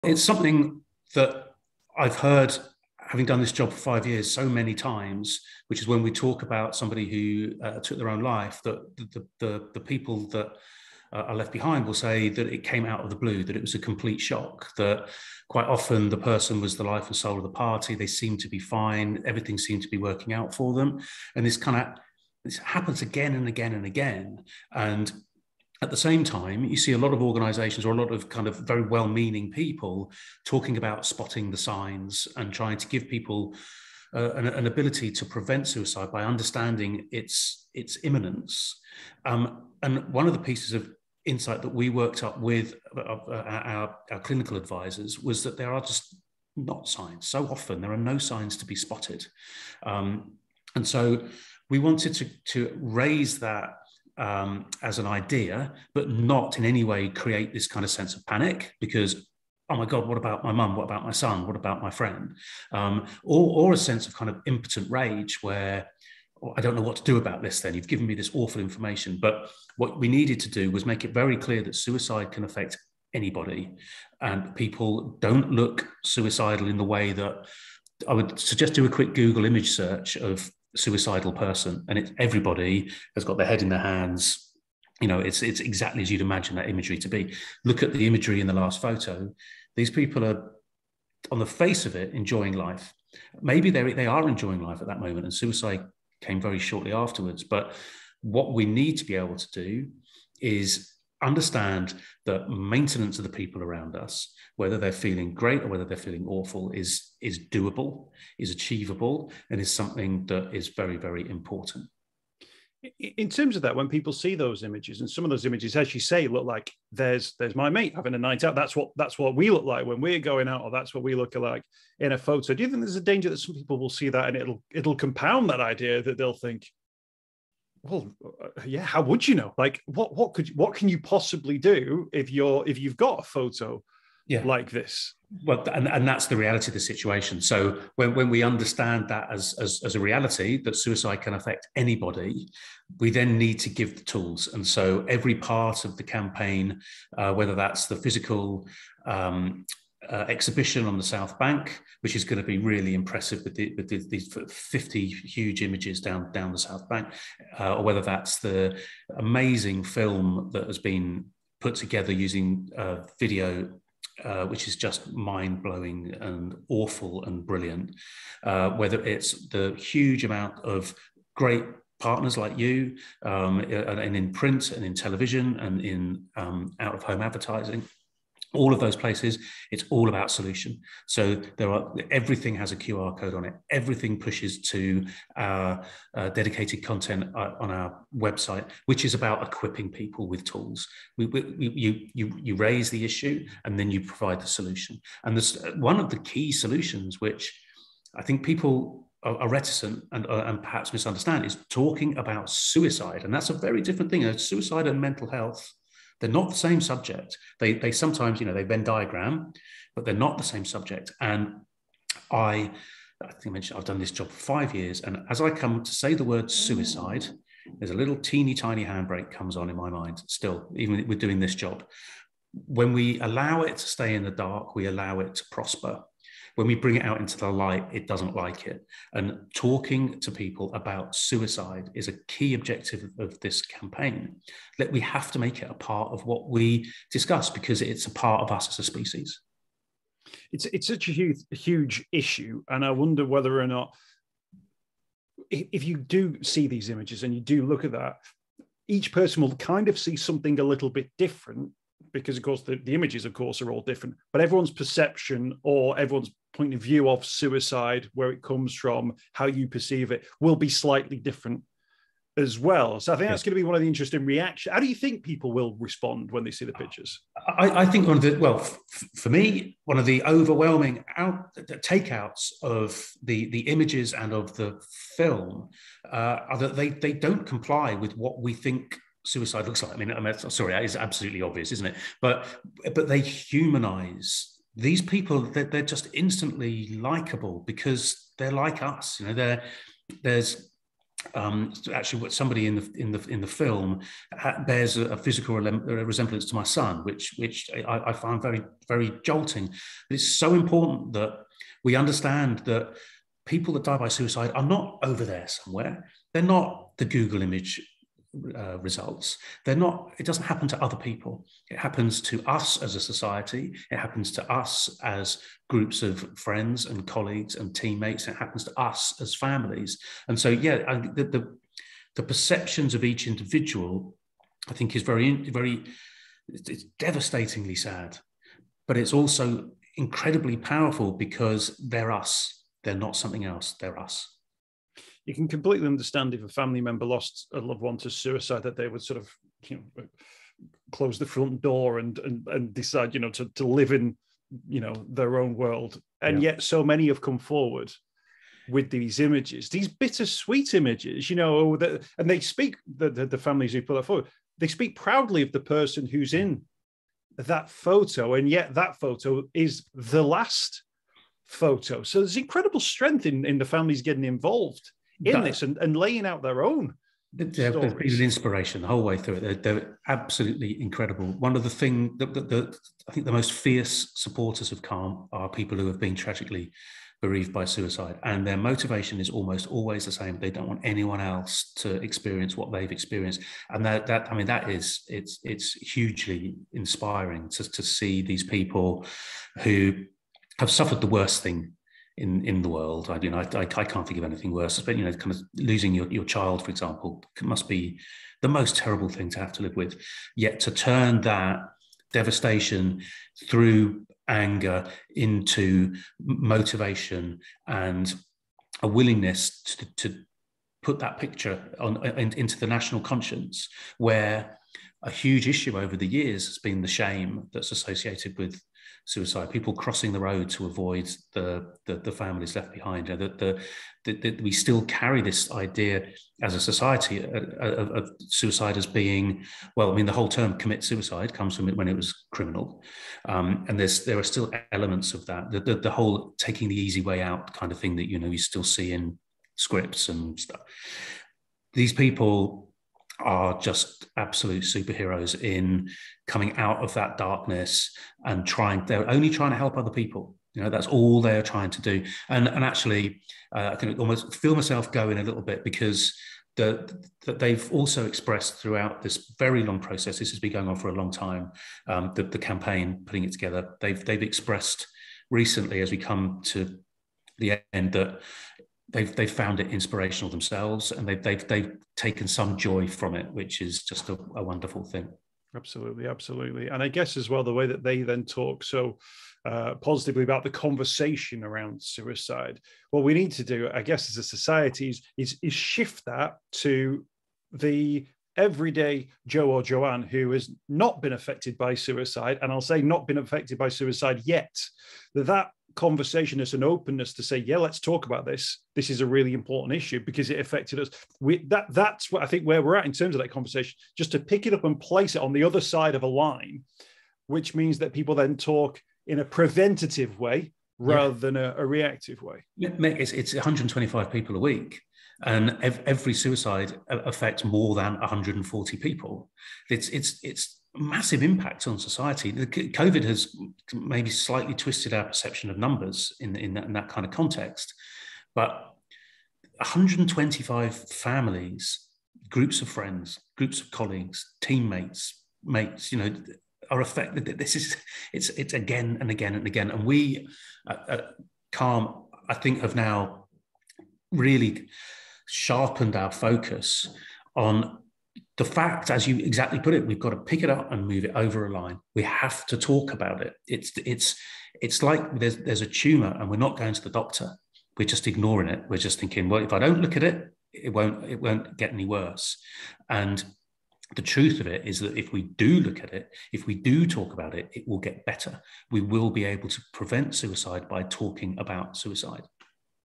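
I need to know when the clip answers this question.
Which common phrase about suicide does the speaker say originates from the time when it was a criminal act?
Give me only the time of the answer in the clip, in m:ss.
7:10.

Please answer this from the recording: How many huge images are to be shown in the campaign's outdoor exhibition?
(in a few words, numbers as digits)
50.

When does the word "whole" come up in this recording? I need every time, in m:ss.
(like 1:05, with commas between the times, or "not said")
6:08, 7:10, 7:15.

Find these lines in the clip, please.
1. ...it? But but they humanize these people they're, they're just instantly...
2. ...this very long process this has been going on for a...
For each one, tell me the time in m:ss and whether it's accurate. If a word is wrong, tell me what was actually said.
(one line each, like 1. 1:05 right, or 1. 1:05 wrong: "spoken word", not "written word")
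1. 4:41 right
2. 7:39 right.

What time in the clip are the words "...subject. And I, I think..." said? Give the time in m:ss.
3:30.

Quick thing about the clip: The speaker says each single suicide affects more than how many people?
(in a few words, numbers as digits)
140.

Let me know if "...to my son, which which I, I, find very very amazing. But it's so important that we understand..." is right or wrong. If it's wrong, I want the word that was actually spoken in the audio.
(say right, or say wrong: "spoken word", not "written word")
wrong: "jolting", not "amazing".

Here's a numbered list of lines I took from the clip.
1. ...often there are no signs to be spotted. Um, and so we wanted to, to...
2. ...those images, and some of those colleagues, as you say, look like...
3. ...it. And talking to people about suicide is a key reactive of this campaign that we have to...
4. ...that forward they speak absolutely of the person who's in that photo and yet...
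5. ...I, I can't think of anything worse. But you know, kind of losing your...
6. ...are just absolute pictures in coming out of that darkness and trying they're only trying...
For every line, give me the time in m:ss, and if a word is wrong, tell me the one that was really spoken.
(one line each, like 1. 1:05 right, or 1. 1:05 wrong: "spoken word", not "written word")
1. 0:47 right
2. 1:54 wrong: "images", not "colleagues"
3. 3:48 wrong: "objective", not "reactive"
4. 5:53 wrong: "proudly", not "absolutely"
5. 6:33 right
6. 7:23 wrong: "superheroes", not "pictures".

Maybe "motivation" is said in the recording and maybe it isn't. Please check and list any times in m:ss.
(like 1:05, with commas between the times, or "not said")
6:18, 6:46.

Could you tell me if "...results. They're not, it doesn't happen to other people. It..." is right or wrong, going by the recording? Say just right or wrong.
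right.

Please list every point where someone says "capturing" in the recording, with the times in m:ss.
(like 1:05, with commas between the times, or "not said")
not said.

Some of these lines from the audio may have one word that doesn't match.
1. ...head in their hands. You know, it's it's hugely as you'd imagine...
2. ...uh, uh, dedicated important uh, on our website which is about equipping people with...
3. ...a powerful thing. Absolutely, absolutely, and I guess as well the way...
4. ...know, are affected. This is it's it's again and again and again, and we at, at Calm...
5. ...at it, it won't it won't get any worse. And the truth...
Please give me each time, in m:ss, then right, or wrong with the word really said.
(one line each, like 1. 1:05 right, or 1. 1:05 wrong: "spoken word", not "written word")
1. 1:23 wrong: "exactly", not "hugely"
2. 3:06 wrong: "content", not "important"
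3. 7:54 wrong: "wonderful", not "powerful"
4. 8:55 right
5. 9:19 right.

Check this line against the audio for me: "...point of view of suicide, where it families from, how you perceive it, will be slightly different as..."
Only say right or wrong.
wrong.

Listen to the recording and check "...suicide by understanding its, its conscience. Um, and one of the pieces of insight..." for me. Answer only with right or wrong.
wrong.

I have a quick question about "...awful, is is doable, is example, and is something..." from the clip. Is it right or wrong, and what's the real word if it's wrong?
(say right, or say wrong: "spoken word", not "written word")
wrong: "achievable", not "example".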